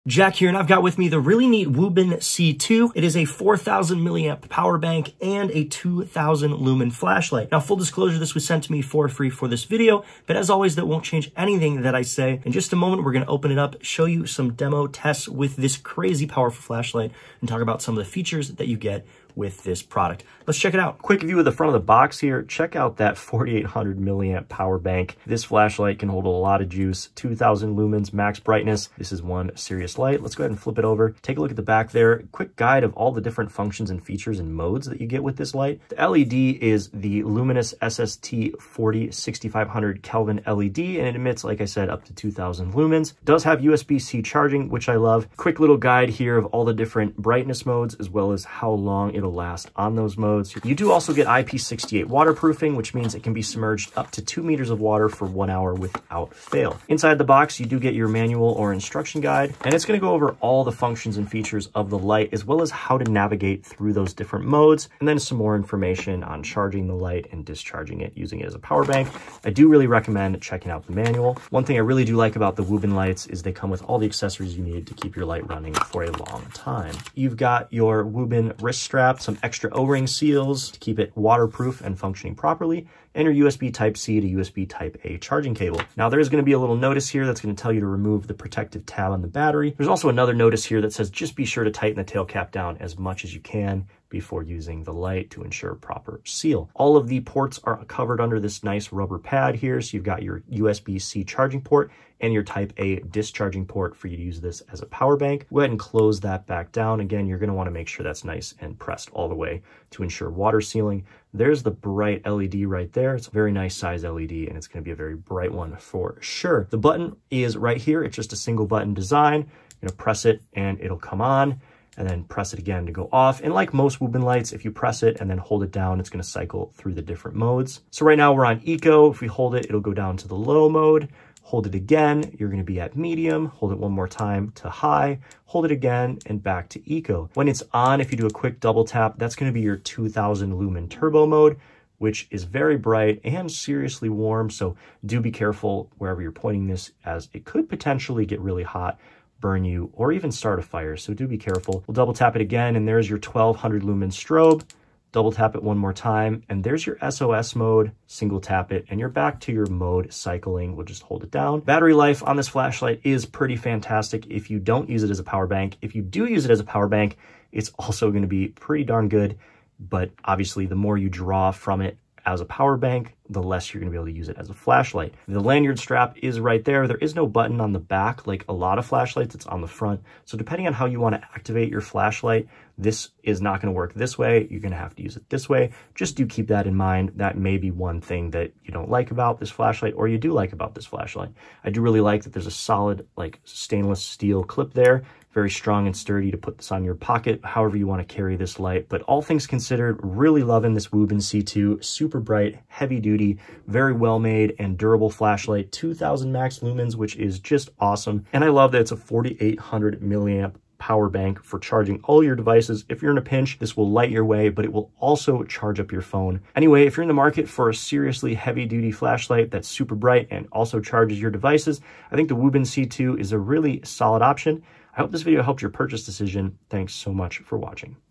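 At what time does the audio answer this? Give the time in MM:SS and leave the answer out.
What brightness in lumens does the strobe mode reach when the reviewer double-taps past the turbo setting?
02:33.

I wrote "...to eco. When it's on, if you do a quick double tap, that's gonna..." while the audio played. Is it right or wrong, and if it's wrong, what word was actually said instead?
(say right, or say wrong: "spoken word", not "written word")
right.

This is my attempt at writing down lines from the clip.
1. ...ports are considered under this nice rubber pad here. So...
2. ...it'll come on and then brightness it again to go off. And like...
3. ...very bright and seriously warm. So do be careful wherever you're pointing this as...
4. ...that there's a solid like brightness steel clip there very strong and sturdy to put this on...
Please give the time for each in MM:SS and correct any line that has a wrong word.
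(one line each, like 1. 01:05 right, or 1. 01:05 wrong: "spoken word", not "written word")
1. 01:37 wrong: "covered", not "considered"
2. 02:00 wrong: "press", not "brightness"
3. 02:22 right
4. 03:12 wrong: "stainless", not "brightness".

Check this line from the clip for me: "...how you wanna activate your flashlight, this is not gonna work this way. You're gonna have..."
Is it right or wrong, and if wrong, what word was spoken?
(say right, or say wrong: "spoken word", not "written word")
right.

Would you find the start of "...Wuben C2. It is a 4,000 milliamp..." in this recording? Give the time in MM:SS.
00:01.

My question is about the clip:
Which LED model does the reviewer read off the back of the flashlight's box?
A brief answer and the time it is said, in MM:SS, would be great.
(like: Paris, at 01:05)
Luminus SST 40, at 00:37.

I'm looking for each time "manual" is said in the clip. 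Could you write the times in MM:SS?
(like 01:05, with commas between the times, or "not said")
00:58, 01:10.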